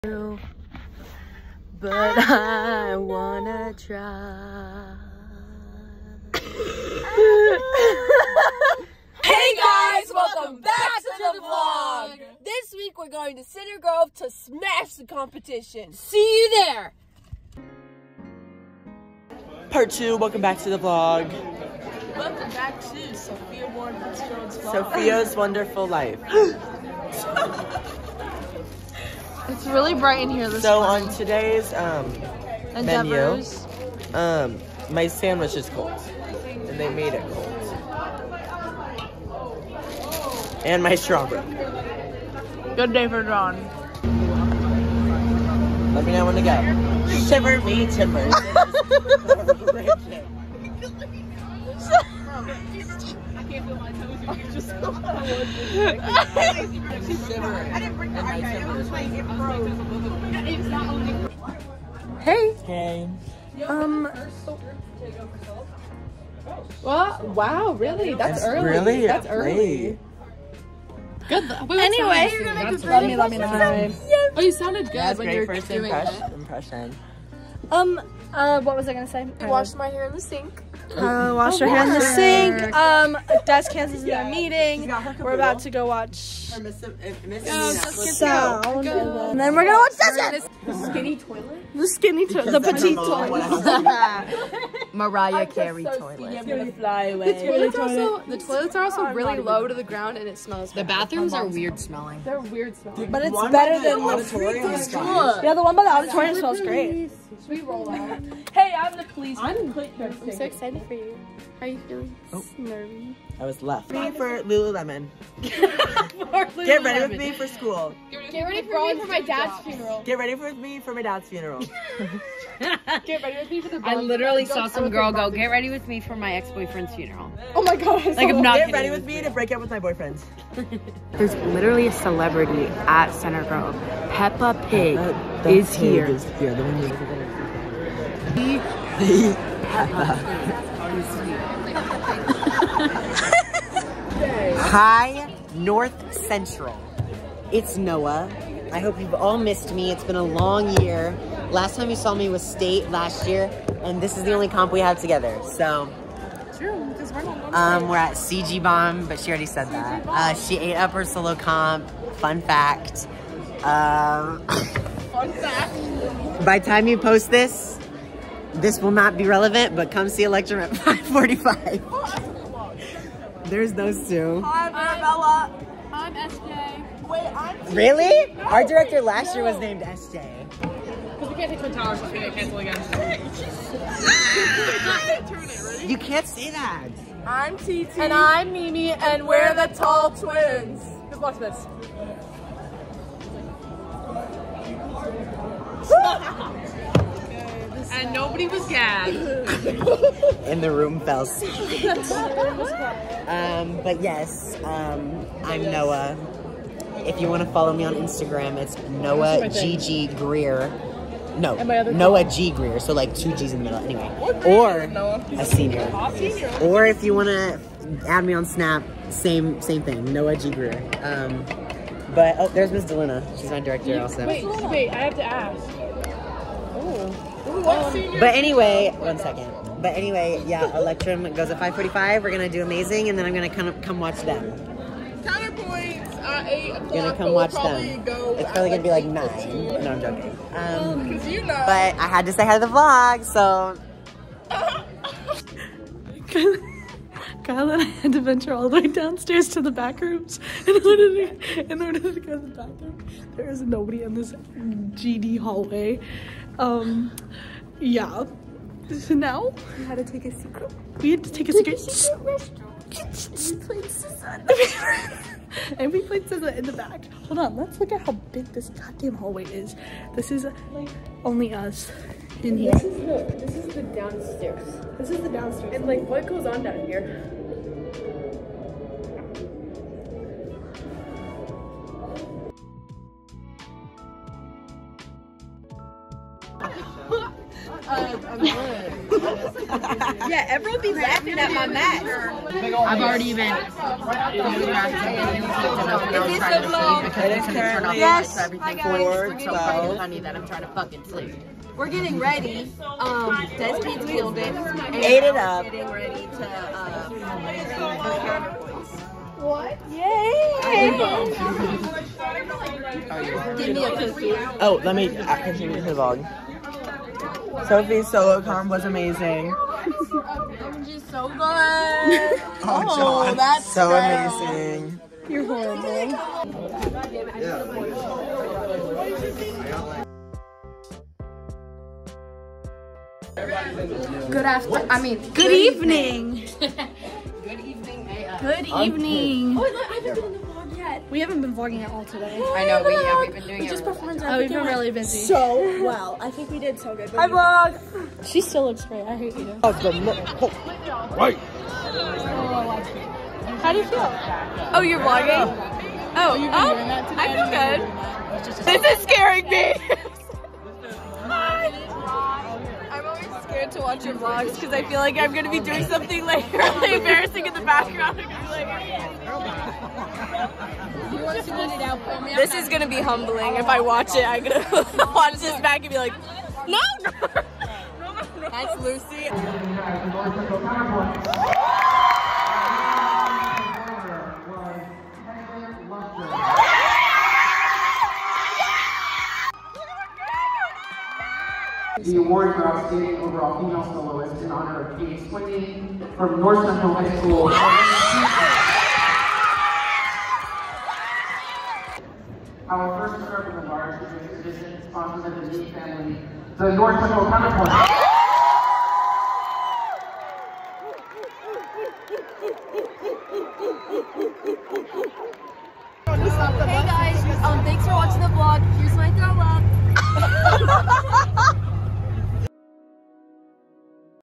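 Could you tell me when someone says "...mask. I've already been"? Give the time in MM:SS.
04:51.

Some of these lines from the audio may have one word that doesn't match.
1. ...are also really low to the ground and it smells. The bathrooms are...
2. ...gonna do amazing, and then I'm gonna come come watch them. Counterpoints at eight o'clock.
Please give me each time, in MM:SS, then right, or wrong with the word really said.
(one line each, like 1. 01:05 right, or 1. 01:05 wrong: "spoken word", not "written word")
1. 01:38 right
2. 03:52 right.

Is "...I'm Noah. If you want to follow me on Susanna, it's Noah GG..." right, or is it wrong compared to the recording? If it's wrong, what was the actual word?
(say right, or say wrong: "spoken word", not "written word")
wrong: "Instagram", not "Susanna".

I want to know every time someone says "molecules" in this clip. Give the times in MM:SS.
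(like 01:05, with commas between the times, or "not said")
not said.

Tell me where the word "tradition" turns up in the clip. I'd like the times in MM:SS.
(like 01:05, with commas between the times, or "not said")
06:44.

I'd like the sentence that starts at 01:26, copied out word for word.
Or miss, miss, eh, miss, no, sound.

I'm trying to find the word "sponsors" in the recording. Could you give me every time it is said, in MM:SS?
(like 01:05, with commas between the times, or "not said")
06:44.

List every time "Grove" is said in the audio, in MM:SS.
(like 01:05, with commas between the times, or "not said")
00:13, 02:13.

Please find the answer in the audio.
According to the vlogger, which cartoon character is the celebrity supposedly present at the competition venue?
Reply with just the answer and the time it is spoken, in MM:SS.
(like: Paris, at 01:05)
Peppa Pig, at 02:14.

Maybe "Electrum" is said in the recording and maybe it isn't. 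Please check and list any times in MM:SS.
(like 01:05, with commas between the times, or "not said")
03:50.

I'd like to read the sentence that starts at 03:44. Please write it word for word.
Wait, wait, I have to ask.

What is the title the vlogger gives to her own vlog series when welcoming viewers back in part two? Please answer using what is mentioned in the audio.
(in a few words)
Sophia's Wonderful Life.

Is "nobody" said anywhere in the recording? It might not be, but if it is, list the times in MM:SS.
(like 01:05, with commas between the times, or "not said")
03:18, 04:13.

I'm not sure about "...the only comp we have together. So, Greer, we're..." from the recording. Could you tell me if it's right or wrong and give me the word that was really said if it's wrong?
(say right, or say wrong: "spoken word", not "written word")
wrong: "True", not "Greer".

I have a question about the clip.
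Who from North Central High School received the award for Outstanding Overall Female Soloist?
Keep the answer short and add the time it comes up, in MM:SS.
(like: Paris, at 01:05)
Katie Swindy, at 06:34.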